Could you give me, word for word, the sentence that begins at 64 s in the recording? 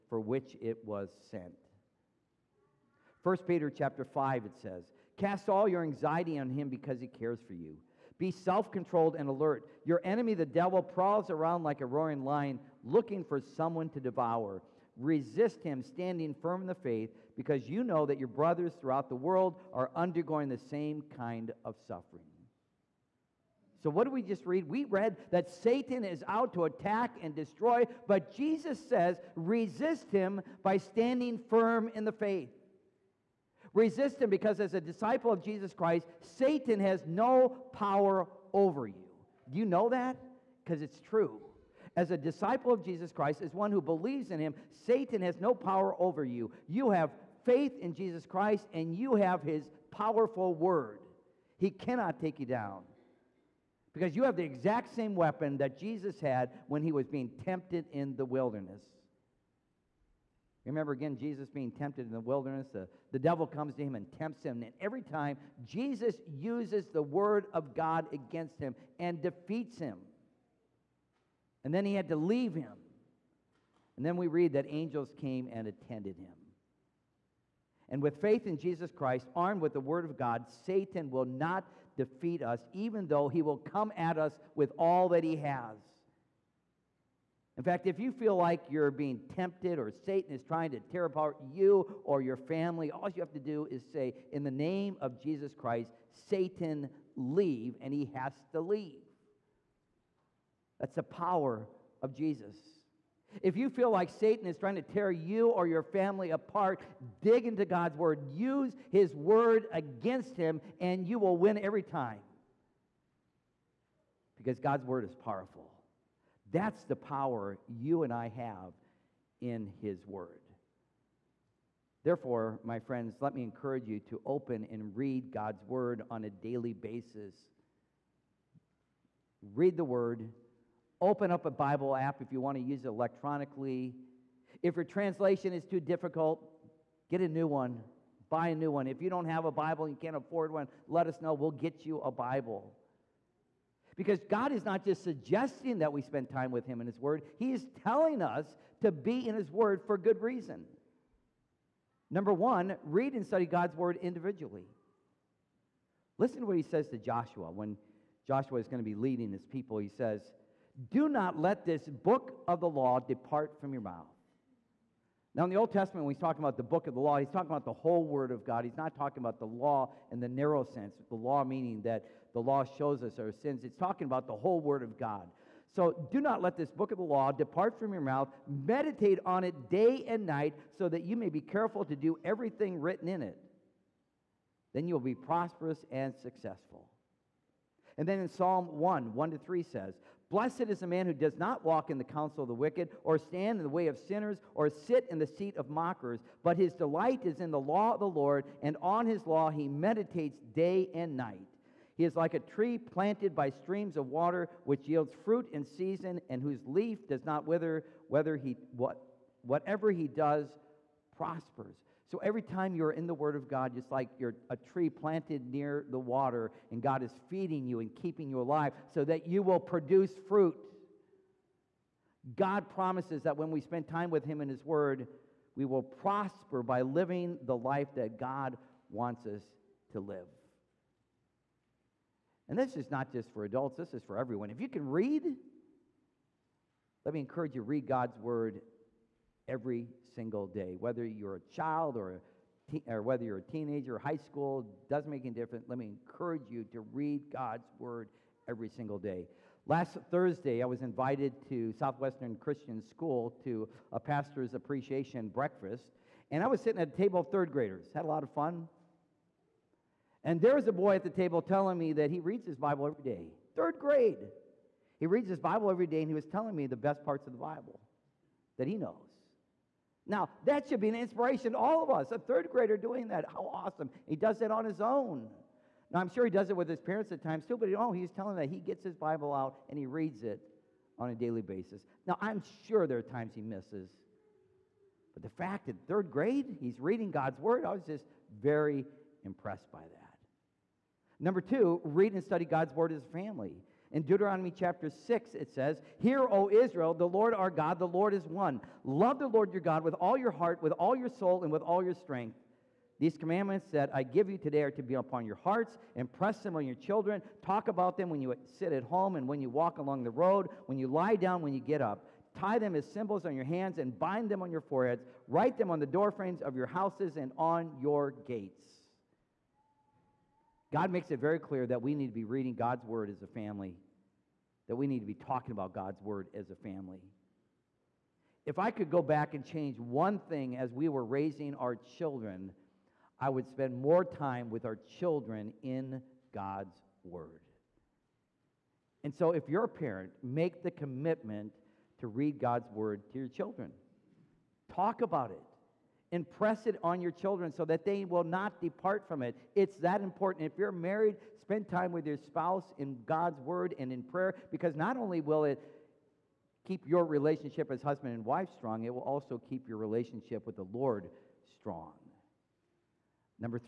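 And every time, Jesus uses the word of God against him and defeats him.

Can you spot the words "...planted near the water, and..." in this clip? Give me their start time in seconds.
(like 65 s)
214 s.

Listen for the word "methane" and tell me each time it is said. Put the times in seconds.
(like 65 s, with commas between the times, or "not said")
not said.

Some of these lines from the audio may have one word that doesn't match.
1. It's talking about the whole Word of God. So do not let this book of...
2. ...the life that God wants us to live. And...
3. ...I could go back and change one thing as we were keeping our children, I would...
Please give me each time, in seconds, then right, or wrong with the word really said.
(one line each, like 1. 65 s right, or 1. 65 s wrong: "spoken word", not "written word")
1. 173 s right
2. 227 s right
3. 328 s wrong: "raising", not "keeping".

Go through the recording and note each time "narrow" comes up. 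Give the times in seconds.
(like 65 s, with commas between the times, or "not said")
170 s.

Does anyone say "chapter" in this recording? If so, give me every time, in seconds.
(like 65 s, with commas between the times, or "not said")
3 s, 294 s.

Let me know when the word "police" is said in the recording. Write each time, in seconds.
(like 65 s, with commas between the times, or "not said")
not said.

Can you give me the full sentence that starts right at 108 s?
Use his word against him, and you will win every time.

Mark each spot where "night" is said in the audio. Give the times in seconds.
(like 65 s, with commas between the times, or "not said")
180 s, 201 s.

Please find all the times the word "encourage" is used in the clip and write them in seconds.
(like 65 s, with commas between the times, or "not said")
123 s, 237 s, 245 s.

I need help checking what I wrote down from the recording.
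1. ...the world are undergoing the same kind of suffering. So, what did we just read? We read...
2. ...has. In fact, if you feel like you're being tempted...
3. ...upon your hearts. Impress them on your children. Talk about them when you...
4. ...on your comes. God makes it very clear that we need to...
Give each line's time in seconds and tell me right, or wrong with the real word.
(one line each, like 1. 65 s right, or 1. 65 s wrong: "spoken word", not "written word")
1. 19 s right
2. 85 s right
3. 304 s right
4. 317 s wrong: "gates", not "comes".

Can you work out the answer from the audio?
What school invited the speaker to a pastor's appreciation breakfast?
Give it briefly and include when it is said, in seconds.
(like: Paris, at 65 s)
Southwestern Christian School, at 251 s.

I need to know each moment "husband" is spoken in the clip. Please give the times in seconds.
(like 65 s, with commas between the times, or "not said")
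357 s.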